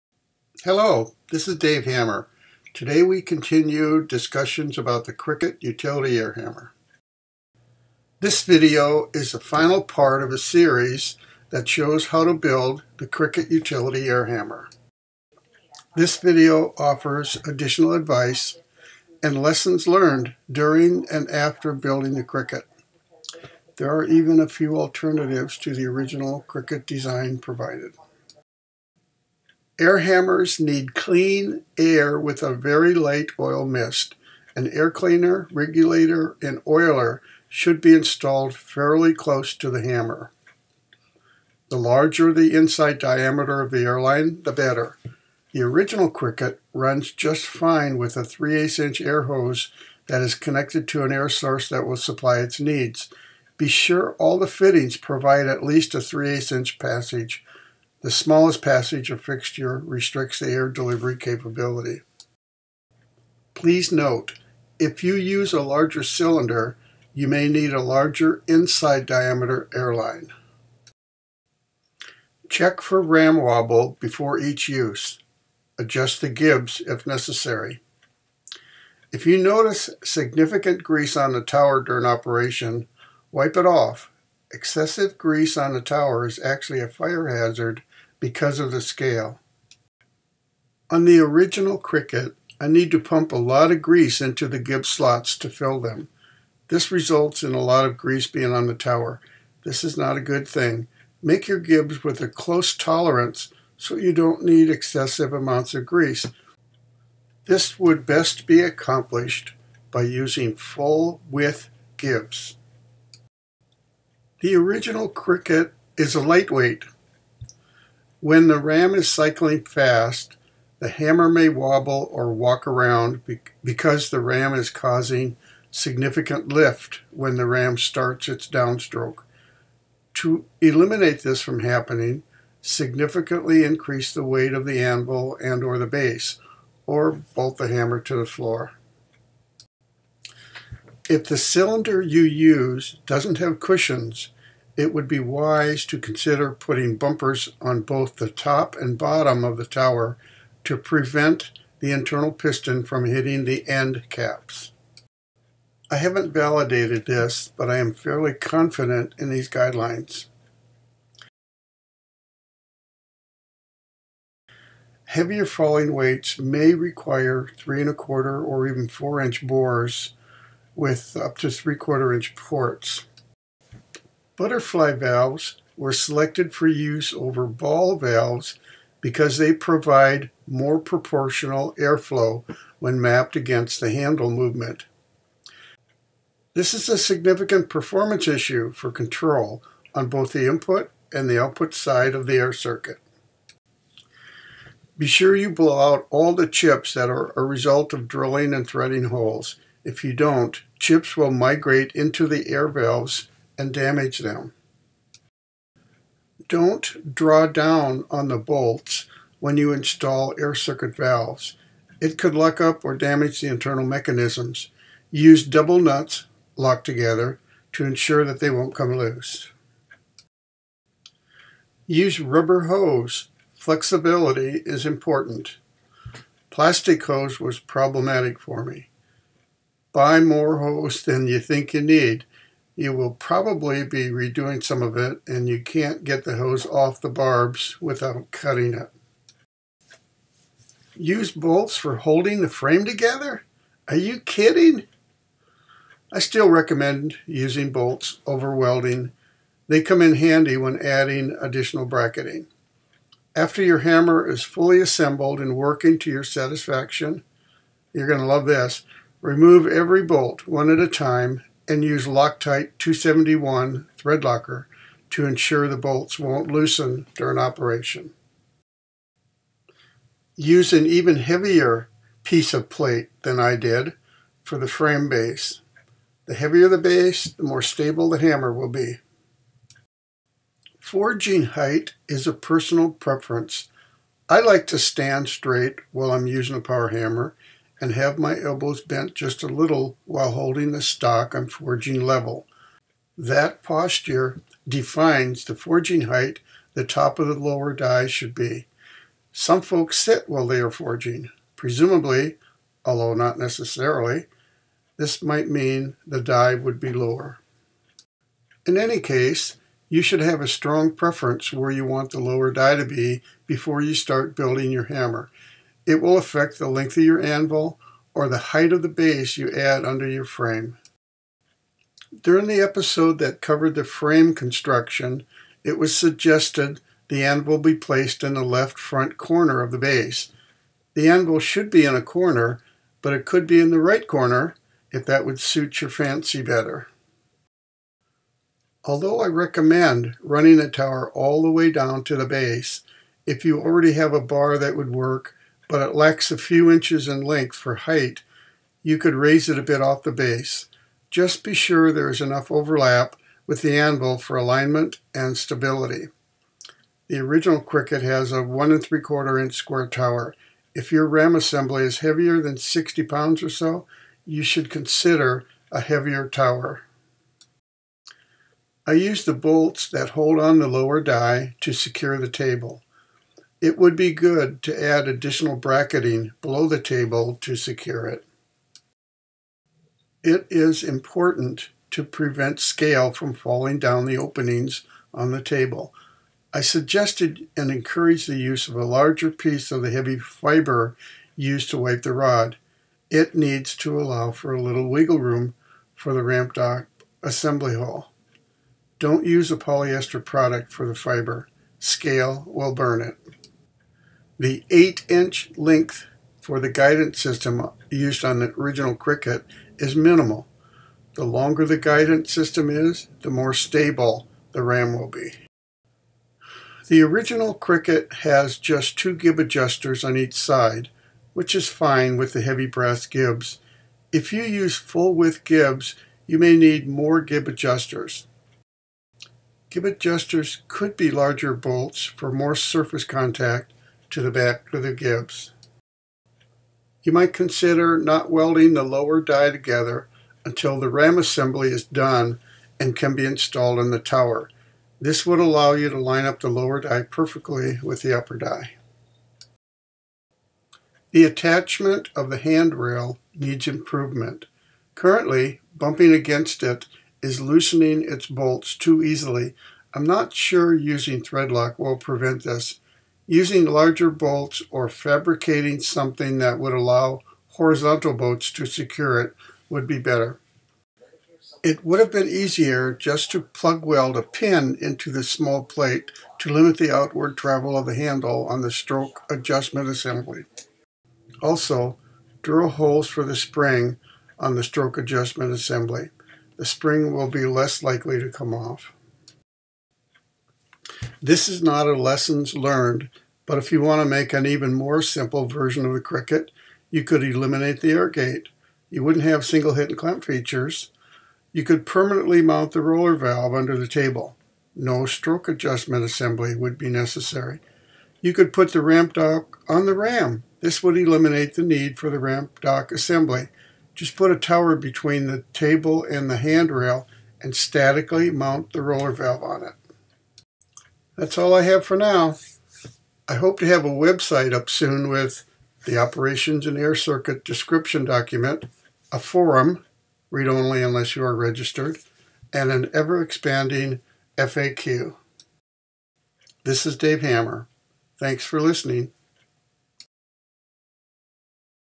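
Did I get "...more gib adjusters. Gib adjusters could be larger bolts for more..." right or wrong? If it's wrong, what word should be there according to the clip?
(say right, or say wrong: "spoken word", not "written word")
right.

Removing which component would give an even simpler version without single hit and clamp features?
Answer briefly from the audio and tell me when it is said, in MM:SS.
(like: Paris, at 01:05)
The air gate, at 08:17.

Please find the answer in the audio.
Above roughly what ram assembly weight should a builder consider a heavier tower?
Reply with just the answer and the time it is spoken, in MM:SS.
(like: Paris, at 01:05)
60 pounds, at 06:02.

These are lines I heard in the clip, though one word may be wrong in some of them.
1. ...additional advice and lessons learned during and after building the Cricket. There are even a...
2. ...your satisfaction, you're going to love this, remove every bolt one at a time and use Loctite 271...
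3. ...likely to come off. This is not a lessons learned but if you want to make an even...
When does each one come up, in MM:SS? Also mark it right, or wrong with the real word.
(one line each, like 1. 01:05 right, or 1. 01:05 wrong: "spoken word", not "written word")
1. 00:17 right
2. 04:16 right
3. 08:07 right.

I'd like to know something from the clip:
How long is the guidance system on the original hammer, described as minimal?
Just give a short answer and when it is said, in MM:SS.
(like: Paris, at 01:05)
8 inches, at 06:44.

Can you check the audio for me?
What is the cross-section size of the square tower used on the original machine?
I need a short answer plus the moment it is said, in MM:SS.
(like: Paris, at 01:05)
1 3/4 inch, at 05:58.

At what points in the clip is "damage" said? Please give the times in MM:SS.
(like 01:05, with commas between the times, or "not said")
03:23, 03:32.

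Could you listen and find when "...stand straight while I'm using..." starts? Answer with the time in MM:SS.
04:44.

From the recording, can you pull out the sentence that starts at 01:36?
This results in a lot of grease being on the tower.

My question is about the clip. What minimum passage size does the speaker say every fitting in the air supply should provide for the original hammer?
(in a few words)
3/8 inch.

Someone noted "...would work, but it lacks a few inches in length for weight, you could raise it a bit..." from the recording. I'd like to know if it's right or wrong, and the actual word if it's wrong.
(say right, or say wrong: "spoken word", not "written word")
wrong: "height", not "weight".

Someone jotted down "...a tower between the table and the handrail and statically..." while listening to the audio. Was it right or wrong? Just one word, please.
right.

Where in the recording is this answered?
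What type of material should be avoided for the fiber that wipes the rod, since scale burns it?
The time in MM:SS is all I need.
06:39.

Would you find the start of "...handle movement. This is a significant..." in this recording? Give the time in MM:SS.
03:03.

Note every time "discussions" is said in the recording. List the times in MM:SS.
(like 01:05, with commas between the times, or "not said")
00:04.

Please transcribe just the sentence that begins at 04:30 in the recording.
Use an even heavier piece of plate than I did for the frame base.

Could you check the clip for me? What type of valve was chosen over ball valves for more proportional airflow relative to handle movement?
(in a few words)
Butterfly valves.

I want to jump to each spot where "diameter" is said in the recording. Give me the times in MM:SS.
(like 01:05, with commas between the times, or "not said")
00:42, 01:09.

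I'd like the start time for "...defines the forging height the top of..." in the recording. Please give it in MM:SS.
04:54.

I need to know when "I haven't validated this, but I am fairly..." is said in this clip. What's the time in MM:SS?
02:35.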